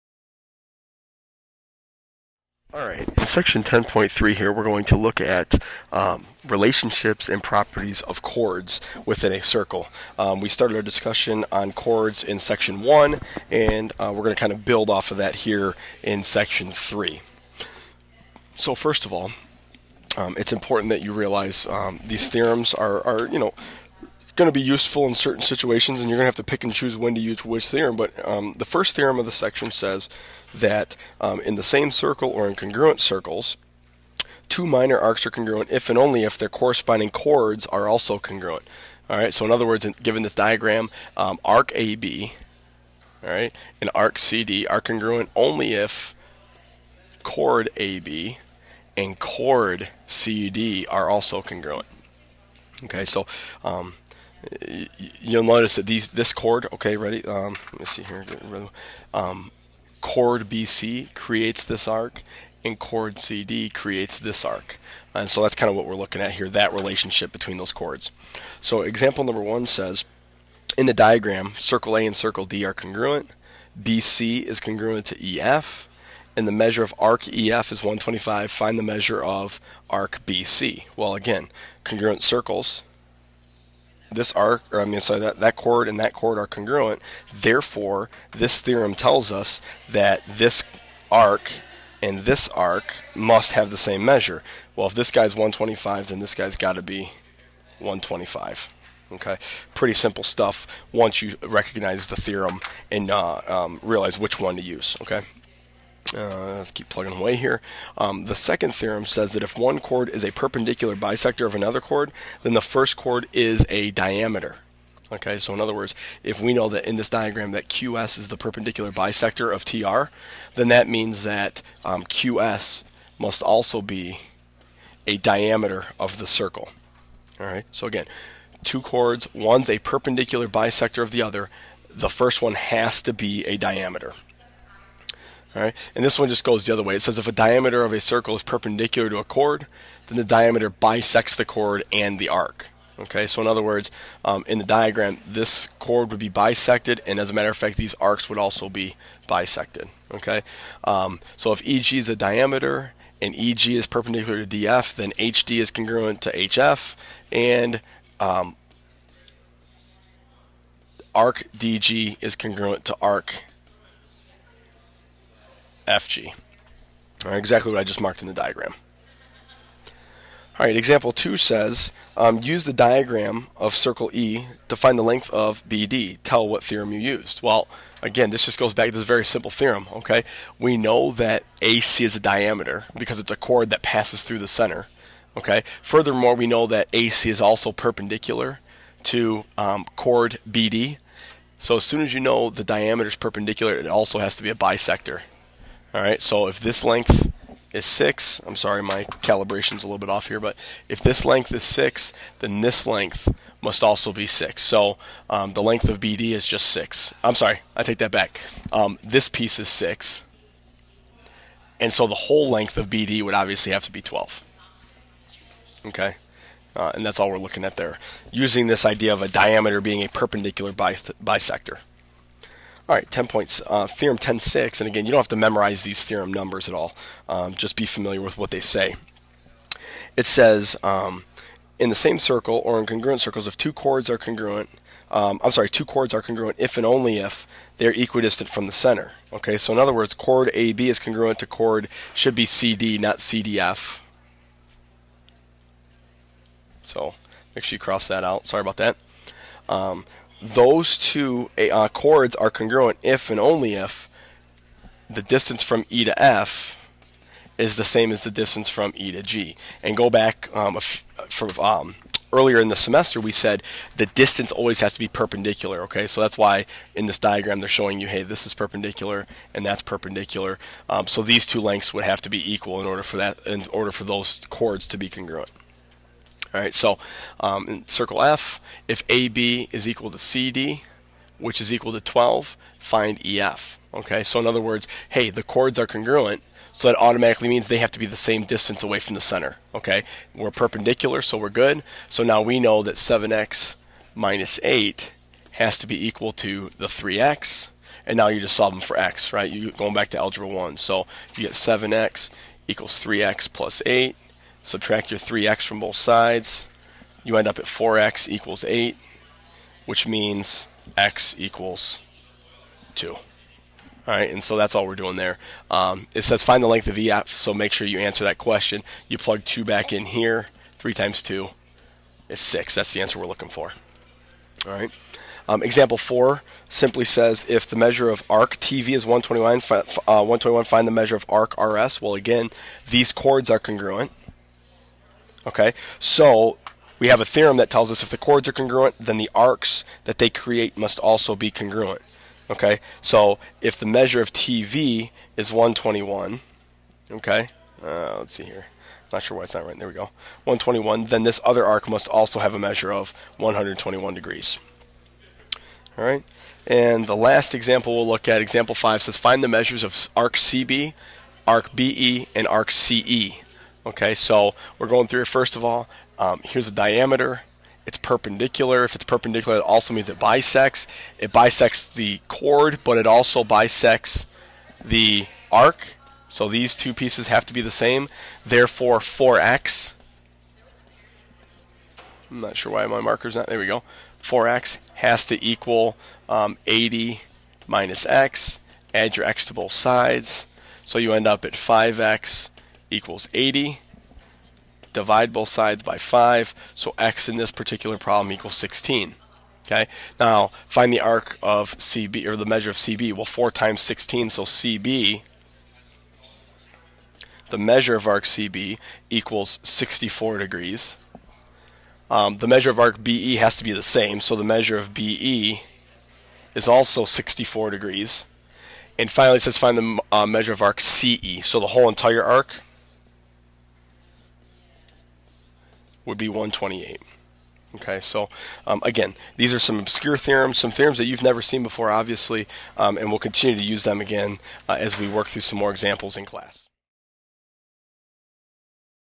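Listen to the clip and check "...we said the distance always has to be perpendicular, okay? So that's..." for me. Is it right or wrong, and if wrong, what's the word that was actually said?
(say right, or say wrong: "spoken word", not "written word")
right.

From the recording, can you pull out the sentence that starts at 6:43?
Well, 4 times 16, so CB, the measure of arc CB equals 64 degrees.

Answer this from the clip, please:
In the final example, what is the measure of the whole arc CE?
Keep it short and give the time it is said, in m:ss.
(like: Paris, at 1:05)
128, at 7:06.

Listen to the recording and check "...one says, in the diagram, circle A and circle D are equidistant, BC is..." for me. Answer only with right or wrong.
wrong.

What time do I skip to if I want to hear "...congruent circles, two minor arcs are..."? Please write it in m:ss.
0:32.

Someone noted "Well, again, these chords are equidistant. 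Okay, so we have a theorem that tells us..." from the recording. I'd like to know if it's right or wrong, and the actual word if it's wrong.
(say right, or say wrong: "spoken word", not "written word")
wrong: "congruent", not "equidistant".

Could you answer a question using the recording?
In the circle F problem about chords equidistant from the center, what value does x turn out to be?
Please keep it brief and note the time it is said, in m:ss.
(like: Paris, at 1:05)
2, at 5:10.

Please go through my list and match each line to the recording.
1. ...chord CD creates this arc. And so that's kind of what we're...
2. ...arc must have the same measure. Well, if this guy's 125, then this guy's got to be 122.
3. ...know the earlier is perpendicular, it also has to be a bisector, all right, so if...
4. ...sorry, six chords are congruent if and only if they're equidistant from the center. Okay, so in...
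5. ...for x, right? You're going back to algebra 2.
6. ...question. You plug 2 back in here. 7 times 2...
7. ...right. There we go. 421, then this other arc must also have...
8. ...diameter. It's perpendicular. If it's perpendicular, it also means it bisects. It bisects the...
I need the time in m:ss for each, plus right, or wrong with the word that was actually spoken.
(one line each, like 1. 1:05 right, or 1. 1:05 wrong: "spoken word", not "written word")
1. 1:02 right
2. 1:32 wrong: "125", not "122"
3. 3:12 wrong: "diameter", not "earlier"
4. 3:55 wrong: "two", not "six"
5. 4:58 wrong: "1", not "2"
6. 5:18 wrong: "3", not "7"
7. 5:49 wrong: "121", not "421"
8. 6:06 right.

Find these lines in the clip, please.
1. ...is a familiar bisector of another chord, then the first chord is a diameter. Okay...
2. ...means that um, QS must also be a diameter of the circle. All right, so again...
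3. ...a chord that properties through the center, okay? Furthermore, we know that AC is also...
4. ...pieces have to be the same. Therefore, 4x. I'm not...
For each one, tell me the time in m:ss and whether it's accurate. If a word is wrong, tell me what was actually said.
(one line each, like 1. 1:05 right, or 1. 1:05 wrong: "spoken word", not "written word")
1. 1:50 wrong: "perpendicular", not "familiar"
2. 2:00 right
3. 3:03 wrong: "passes", not "properties"
4. 6:16 right.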